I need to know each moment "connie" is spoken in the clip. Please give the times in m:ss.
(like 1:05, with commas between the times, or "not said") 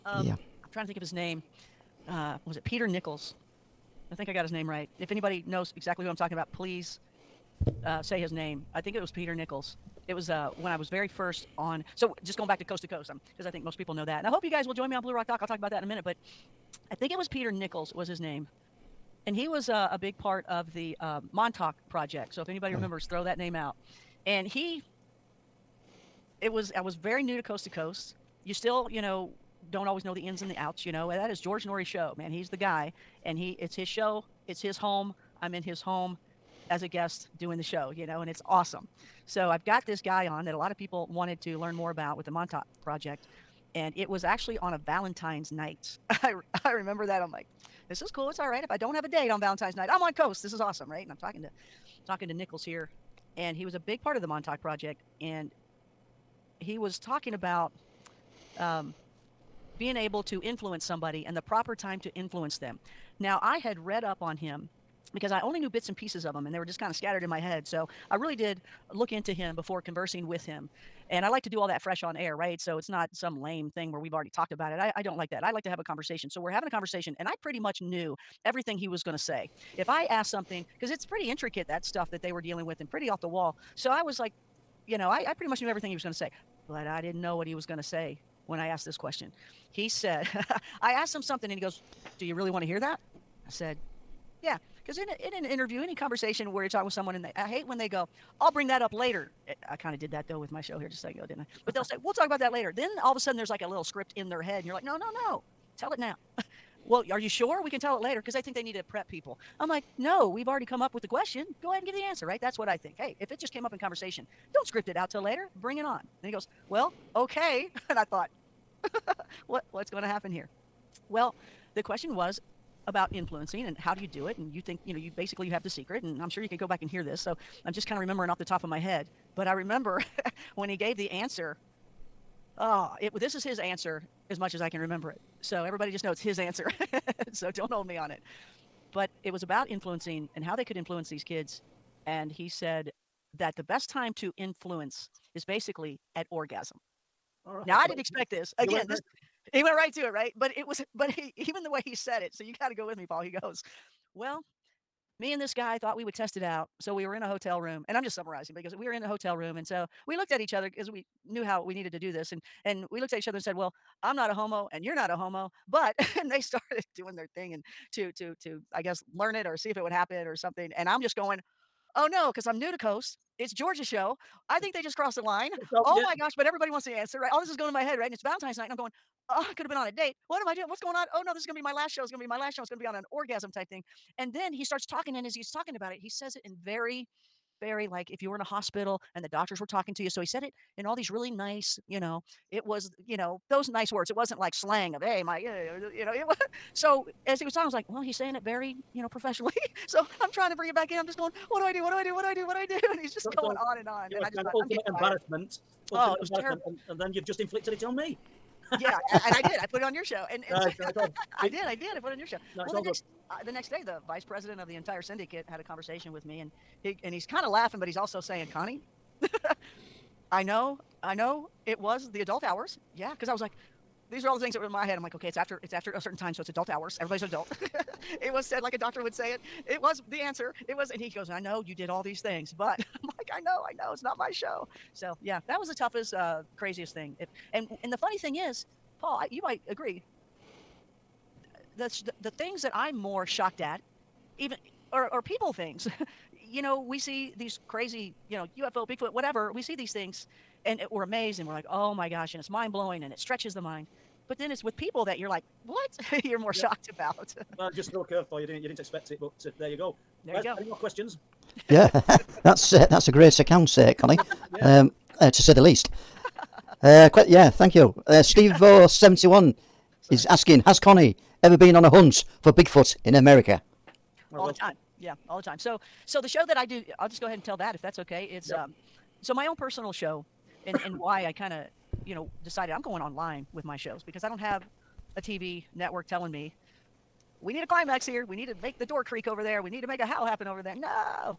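3:38, 4:23, 4:30.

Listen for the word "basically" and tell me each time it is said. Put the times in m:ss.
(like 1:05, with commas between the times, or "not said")
2:05, 2:25.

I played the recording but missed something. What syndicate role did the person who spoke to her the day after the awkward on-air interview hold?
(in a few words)
Vice president.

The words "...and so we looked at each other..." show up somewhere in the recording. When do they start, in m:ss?
2:39.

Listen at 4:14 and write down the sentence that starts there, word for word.
But then it's with people that you're like, what?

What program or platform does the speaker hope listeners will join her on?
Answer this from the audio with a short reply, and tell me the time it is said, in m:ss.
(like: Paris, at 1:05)
Blue Rock Talk, at 0:15.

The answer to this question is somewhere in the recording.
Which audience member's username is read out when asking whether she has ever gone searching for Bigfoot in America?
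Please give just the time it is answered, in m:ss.
4:28.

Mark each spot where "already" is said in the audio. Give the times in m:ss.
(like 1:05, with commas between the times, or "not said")
1:14, 1:50.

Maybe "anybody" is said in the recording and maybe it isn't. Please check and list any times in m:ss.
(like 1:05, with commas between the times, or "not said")
0:05, 0:22.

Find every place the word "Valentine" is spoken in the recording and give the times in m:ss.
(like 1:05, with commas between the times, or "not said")
0:44, 0:49, 2:58.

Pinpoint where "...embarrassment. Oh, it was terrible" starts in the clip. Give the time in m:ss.
3:24.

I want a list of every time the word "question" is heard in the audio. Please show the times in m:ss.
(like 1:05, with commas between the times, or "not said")
1:28, 1:51, 2:01, 4:20.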